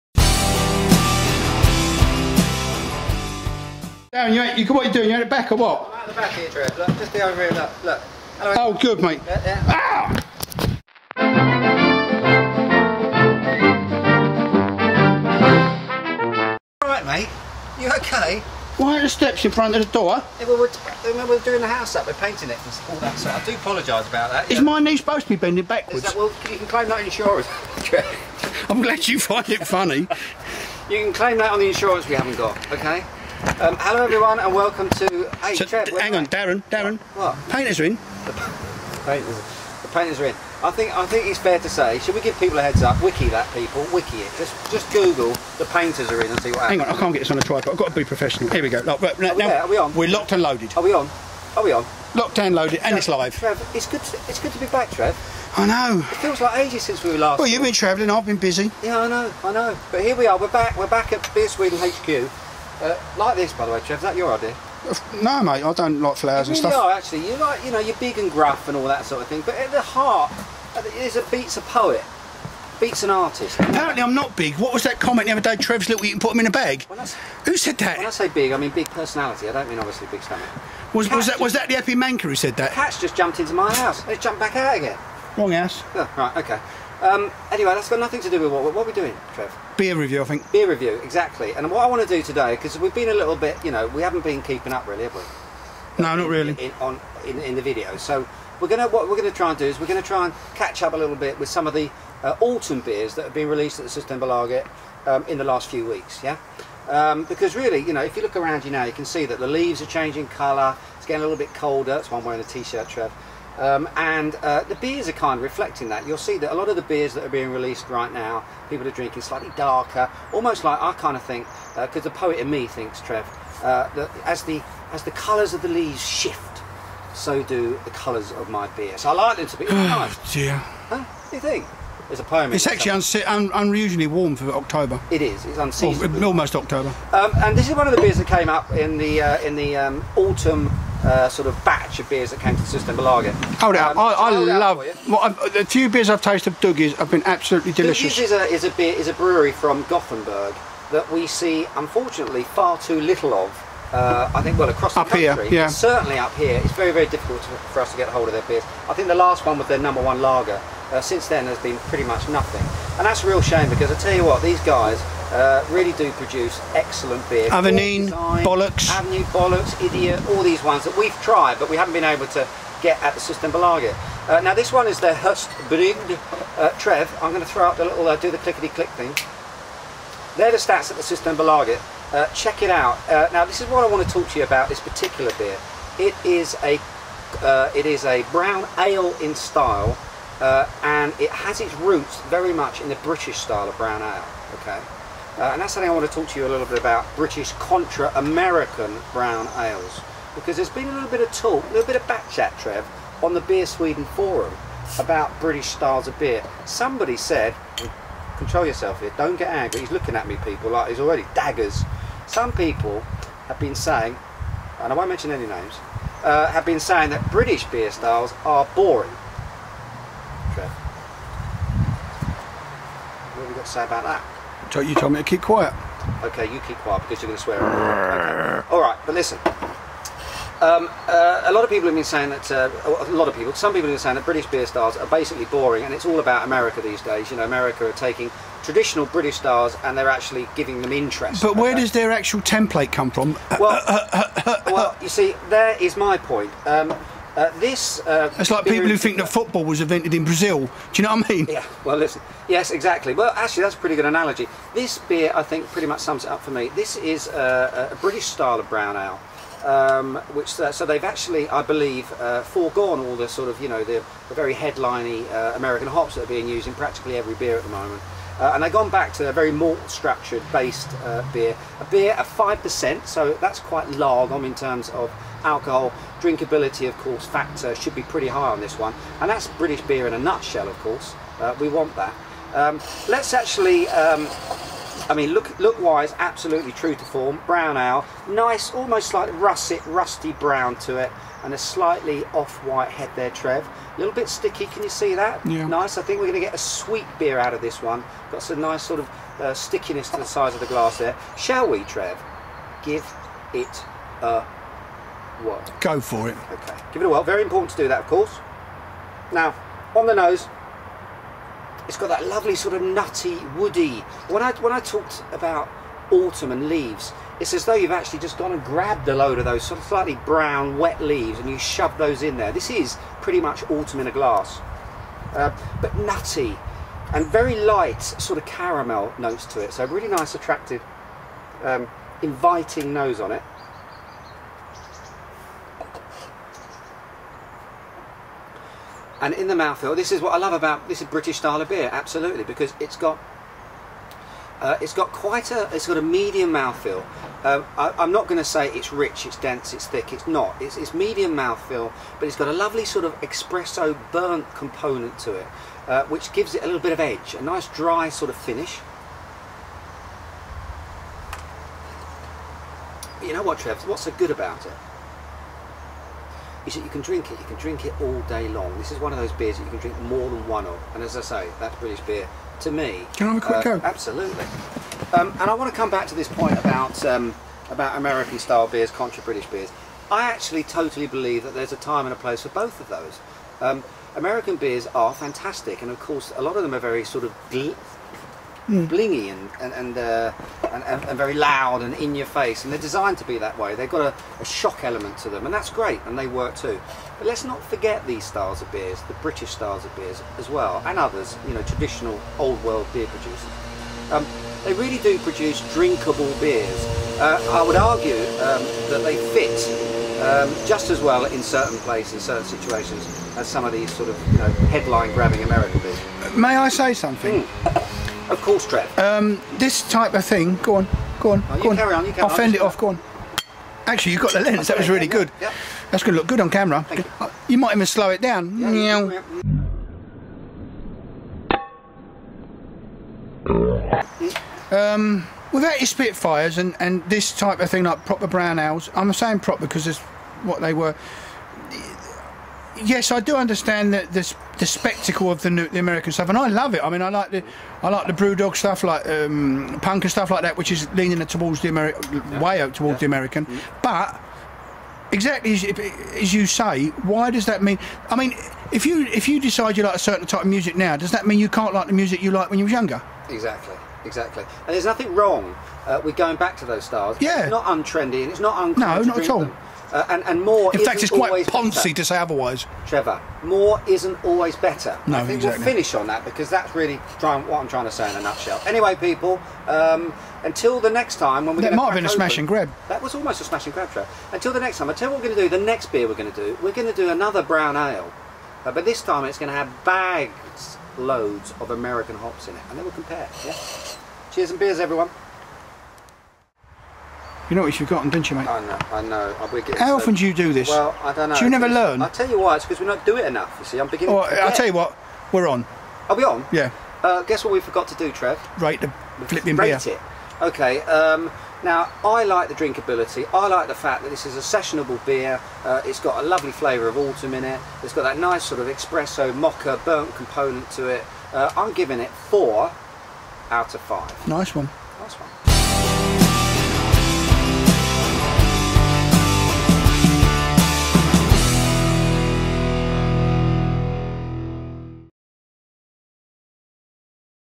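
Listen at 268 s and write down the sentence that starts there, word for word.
Uh, and I've gone back to a very malt structured based uh, beer.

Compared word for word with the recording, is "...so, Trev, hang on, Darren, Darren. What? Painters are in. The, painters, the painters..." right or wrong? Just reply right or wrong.
right.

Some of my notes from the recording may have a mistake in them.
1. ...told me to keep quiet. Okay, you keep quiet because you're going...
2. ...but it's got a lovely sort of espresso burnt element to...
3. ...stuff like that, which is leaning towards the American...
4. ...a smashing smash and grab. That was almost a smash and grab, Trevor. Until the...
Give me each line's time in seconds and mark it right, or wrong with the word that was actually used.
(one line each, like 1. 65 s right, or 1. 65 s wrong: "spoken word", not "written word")
1. 224 s right
2. 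352 s wrong: "component", not "element"
3. 450 s right
4. 482 s right.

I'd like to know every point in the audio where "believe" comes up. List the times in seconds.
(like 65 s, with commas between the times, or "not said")
261 s, 381 s.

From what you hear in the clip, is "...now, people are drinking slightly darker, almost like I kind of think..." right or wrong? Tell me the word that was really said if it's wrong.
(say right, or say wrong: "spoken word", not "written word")
right.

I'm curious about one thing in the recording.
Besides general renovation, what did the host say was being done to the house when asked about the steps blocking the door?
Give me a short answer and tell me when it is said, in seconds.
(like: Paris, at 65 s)
Painting, at 22 s.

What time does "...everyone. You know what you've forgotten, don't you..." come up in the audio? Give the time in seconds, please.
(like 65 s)
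494 s.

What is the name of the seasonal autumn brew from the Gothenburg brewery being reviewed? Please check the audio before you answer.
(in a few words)
Höstbrygd.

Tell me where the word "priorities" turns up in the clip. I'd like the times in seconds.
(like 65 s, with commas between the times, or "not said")
not said.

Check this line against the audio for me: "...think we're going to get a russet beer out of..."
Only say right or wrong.
wrong.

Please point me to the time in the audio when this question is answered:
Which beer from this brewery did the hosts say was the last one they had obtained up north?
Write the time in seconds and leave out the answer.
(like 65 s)
159 s.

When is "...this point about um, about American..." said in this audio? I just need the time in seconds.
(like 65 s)
376 s.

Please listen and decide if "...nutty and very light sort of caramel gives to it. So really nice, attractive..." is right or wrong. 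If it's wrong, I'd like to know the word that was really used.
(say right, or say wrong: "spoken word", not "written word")
wrong: "notes", not "gives".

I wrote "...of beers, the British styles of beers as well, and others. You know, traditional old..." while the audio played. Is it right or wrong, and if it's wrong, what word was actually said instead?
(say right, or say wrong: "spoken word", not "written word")
right.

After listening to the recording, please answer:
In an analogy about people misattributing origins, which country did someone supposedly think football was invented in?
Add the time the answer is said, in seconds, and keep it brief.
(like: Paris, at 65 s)
Brazil, at 250 s.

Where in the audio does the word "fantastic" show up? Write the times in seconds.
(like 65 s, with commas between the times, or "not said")
385 s.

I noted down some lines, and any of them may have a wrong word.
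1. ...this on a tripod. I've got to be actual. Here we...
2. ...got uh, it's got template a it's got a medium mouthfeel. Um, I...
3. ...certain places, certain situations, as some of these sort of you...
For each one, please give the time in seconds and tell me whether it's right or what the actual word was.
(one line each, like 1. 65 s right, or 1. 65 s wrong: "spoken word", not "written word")
1. 47 s wrong: "professional", not "actual"
2. 342 s wrong: "quite", not "template"
3. 411 s right.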